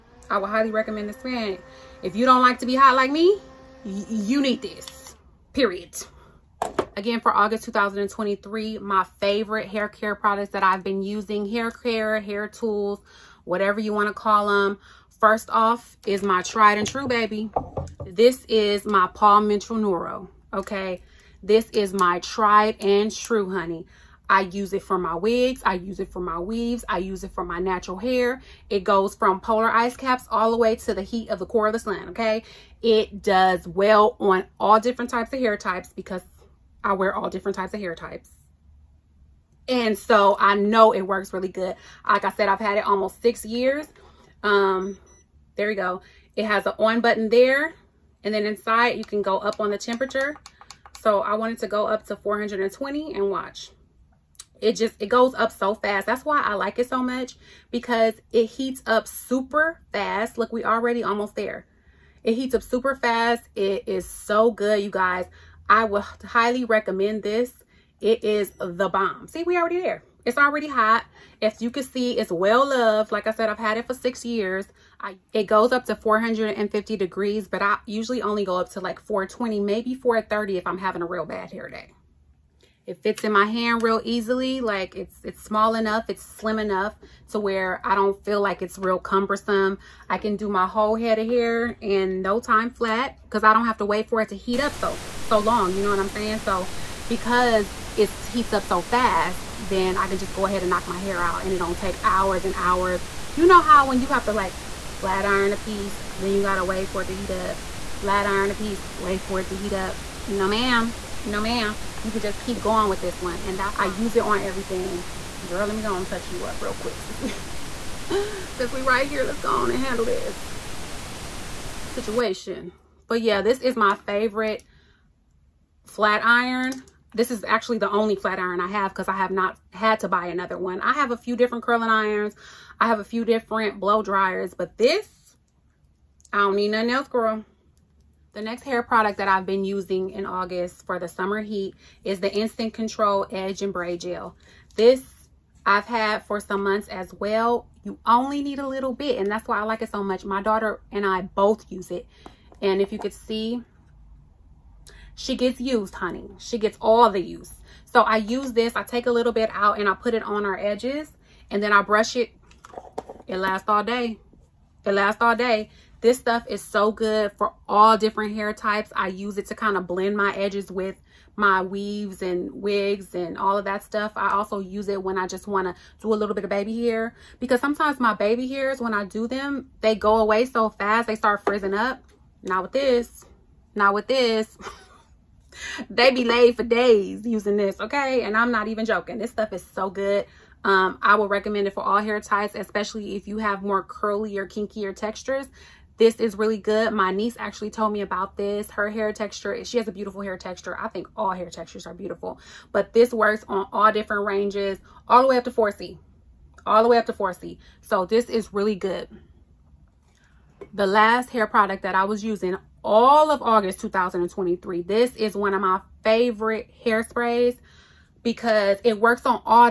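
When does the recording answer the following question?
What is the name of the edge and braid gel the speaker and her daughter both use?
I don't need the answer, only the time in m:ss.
2:22.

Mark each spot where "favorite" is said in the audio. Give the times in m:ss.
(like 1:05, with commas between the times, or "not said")
0:09, 2:03, 3:36.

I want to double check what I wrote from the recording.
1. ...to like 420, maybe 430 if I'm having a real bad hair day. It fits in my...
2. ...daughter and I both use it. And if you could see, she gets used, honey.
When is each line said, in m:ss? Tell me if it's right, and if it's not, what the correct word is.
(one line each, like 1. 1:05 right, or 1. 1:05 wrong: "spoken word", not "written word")
1. 1:18 right
2. 2:30 right.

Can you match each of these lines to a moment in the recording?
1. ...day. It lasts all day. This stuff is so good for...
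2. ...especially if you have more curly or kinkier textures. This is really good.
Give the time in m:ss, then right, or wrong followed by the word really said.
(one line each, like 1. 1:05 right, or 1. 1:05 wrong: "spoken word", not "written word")
1. 2:43 right
2. 3:12 right.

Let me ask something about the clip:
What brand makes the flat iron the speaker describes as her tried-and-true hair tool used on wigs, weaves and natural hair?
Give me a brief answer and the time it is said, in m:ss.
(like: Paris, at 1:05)
Paul Mitchell, at 0:19.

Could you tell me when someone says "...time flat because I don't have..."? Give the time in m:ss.
1:32.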